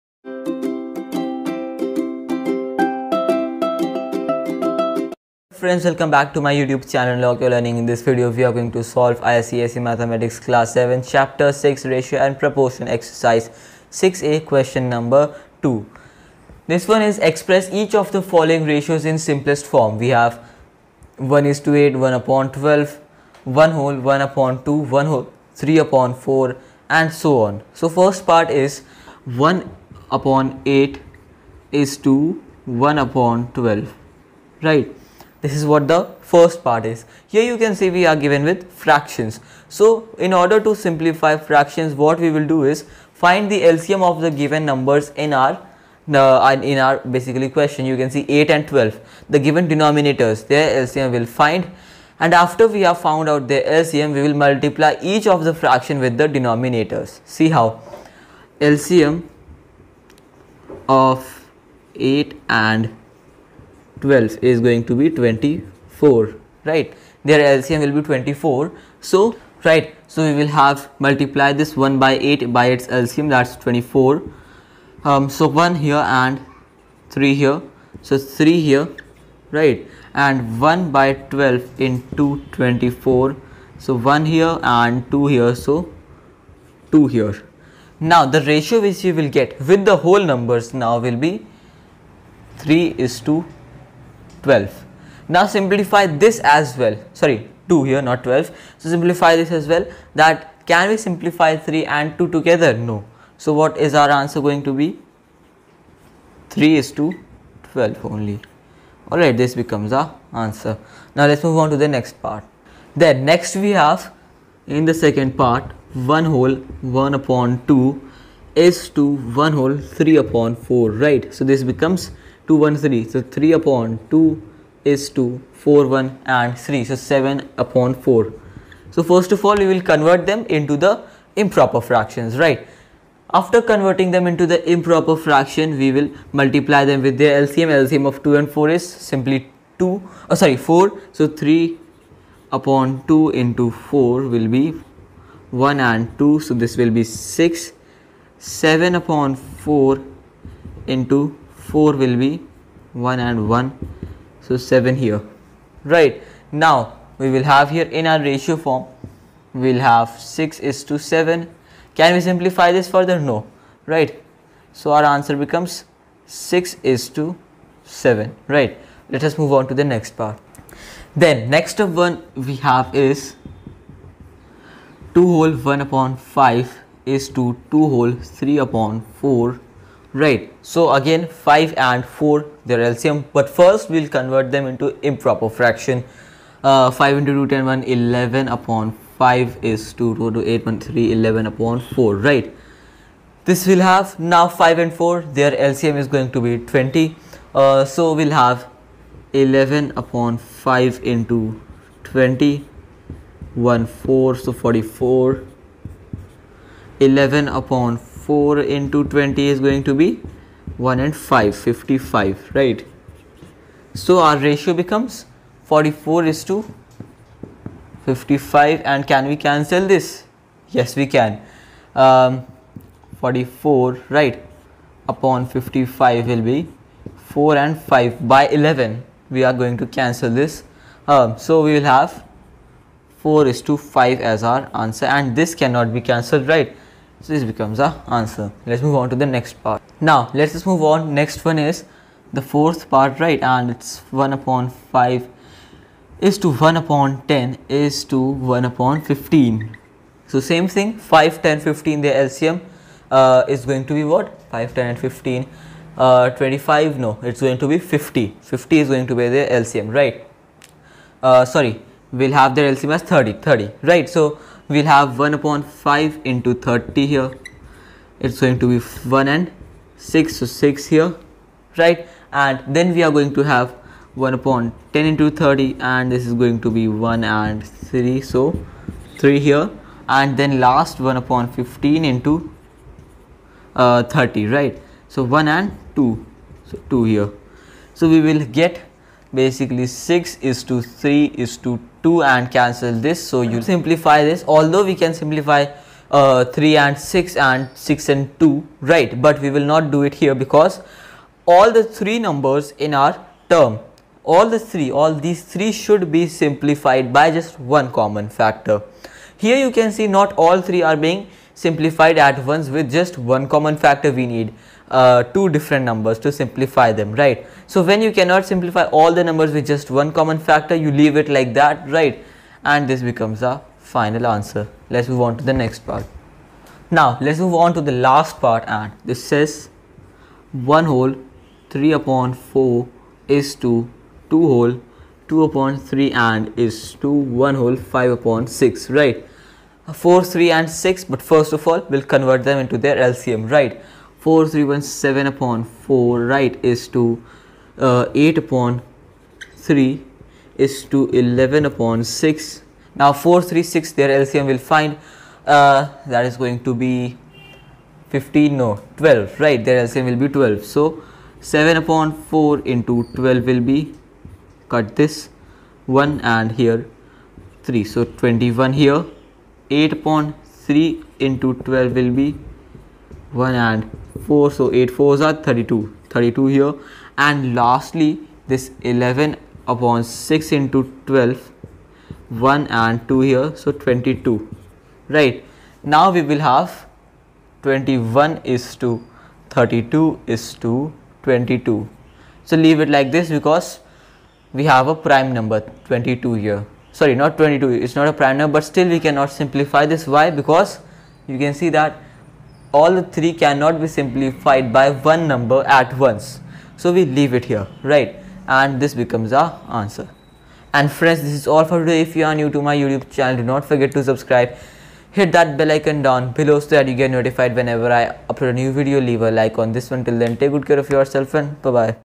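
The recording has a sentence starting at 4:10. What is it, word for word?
So same thing 5, 10, 15 the LCM uh, is going to be what?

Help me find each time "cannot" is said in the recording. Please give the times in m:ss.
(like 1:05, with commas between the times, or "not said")
3:55, 5:18, 6:38, 6:43.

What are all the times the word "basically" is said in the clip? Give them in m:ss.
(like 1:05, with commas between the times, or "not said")
0:46, 4:49.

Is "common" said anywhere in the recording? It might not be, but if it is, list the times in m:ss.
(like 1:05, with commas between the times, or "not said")
5:07, 5:13, 5:20.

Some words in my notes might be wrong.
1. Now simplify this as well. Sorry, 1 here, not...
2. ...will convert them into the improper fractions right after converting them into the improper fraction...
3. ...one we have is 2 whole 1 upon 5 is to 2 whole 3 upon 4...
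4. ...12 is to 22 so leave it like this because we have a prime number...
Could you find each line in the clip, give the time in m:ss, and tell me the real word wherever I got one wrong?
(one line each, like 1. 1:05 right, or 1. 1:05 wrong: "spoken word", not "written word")
1. 1:35 wrong: "2", not "1"
2. 2:09 right
3. 2:52 right
4. 6:29 wrong: "32", not "12".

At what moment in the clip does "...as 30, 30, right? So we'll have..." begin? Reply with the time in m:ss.
4:22.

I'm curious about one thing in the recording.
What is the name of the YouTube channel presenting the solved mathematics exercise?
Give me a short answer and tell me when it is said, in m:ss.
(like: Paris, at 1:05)
Unlock Your Learning, at 0:07.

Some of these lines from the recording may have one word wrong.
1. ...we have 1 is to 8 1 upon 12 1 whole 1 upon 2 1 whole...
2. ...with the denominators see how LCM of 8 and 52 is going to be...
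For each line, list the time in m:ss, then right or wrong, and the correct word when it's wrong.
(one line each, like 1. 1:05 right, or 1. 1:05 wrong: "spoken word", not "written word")
1. 0:19 right
2. 0:55 wrong: "12", not "52".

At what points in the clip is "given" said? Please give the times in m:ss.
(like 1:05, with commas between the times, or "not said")
0:38, 0:44, 0:49.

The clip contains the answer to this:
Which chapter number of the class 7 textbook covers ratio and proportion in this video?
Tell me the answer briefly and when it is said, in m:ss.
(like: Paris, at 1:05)
6, at 0:11.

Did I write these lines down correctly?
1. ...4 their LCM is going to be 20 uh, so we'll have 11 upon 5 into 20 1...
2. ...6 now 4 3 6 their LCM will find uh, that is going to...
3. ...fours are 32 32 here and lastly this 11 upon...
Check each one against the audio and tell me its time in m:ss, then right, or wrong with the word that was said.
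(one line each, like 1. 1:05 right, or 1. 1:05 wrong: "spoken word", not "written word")
1. 3:14 right
2. 5:52 right
3. 6:14 right.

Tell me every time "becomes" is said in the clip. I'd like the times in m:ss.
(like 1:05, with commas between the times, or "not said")
1:49, 2:01, 2:45, 3:34, 3:57, 5:23, 6:48.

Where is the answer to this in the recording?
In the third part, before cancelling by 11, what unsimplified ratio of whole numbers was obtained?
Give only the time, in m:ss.
3:35.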